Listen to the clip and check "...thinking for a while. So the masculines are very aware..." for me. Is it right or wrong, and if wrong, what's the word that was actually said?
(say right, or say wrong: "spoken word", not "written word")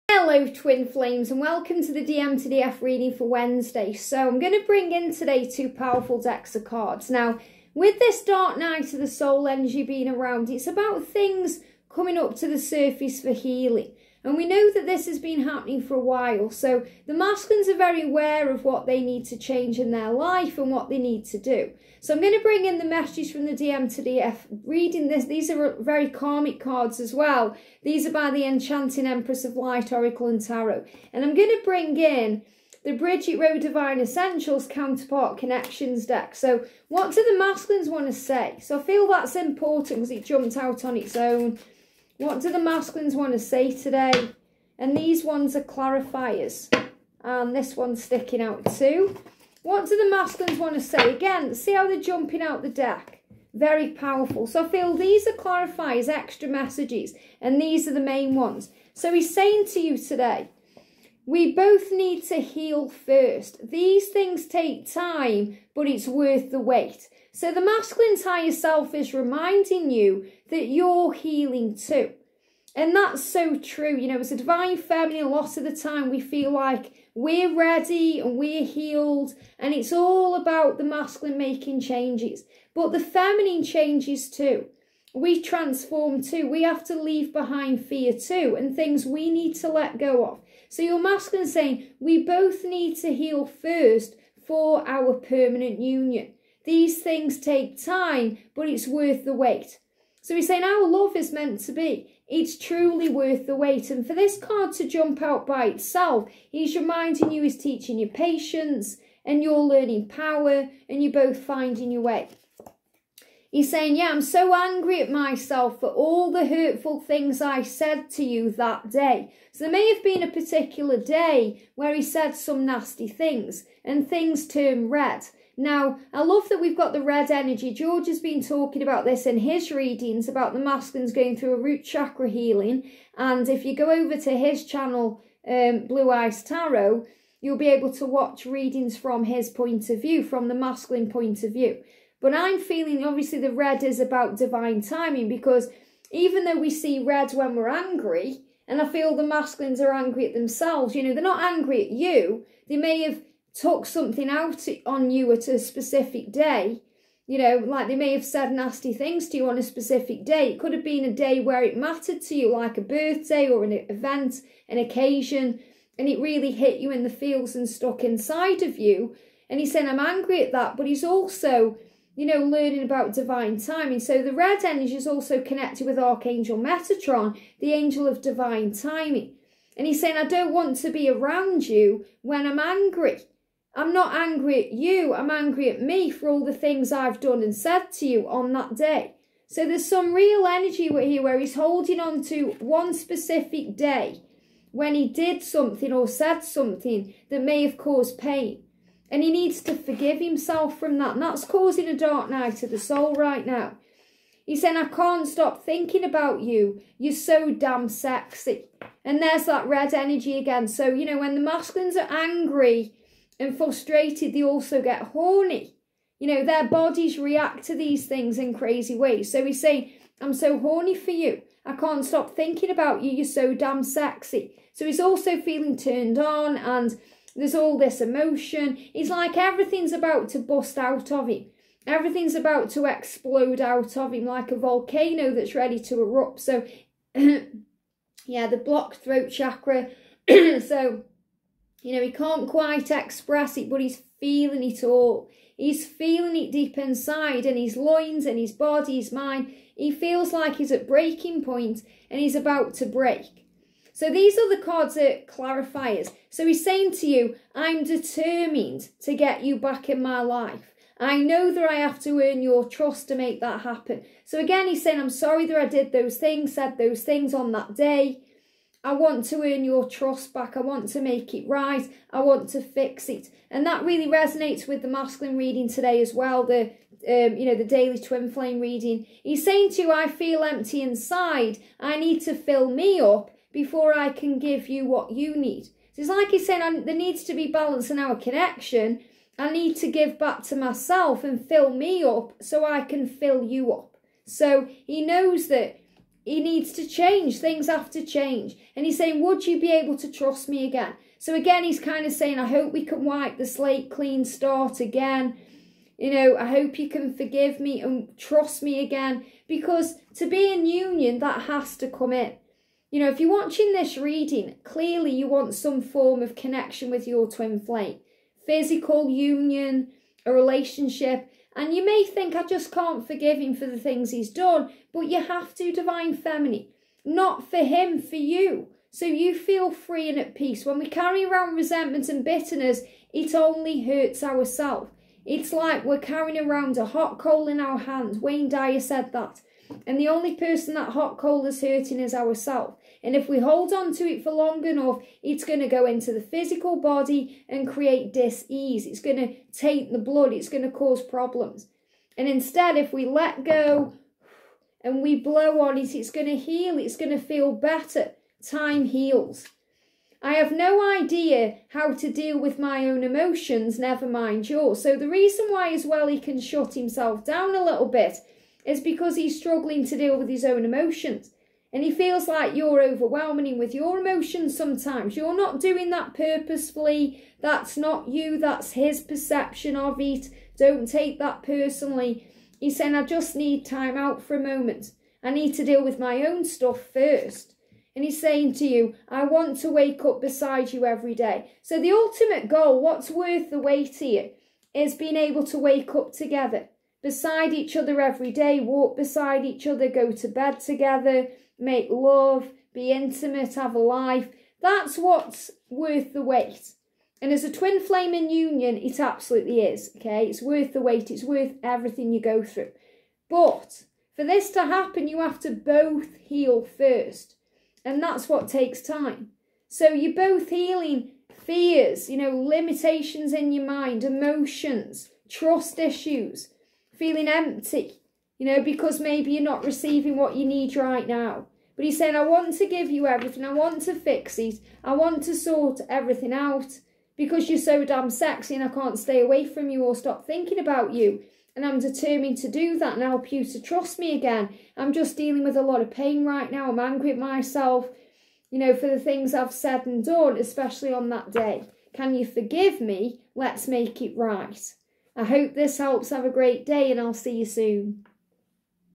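wrong: "happening", not "thinking".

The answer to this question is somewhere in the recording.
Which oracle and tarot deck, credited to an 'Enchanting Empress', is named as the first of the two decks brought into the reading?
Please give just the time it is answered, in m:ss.
0:29.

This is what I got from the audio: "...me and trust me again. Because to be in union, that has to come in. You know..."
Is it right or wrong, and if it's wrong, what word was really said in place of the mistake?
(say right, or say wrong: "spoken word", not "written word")
right.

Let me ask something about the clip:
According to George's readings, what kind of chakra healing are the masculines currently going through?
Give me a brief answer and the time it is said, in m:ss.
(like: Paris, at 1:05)
root chakra, at 2:11.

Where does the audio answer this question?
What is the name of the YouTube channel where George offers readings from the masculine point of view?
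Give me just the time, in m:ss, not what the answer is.
2:15.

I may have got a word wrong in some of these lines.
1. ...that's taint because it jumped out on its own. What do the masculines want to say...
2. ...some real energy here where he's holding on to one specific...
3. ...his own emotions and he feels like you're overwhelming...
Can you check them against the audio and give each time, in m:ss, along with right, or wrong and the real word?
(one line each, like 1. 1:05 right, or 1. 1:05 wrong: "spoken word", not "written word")
1. 0:39 wrong: "important", not "taint"
2. 3:09 right
3. 6:10 right.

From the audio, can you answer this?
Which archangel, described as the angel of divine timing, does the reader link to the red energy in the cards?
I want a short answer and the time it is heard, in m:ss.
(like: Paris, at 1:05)
Archangel Metatron, at 2:55.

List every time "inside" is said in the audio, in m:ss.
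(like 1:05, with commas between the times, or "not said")
2:48, 4:06, 4:40.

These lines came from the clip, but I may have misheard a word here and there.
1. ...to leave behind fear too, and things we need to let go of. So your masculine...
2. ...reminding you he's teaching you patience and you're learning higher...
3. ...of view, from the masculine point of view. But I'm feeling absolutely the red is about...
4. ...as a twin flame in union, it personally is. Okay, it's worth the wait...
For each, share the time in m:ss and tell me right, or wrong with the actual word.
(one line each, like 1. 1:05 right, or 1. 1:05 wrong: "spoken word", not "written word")
1. 1:26 right
2. 1:46 wrong: "power", not "higher"
3. 2:19 wrong: "obviously", not "absolutely"
4. 6:47 wrong: "absolutely", not "personally".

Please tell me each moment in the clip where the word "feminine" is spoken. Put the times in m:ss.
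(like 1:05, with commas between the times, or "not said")
1:14, 1:22, 5:26.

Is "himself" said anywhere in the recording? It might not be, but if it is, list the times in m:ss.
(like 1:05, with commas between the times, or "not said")
3:20, 6:06.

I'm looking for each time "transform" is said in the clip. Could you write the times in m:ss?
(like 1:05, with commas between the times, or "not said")
1:25.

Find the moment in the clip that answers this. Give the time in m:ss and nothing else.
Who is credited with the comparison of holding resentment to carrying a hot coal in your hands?
5:38.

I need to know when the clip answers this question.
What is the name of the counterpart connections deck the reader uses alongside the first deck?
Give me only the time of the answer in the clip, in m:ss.
0:32.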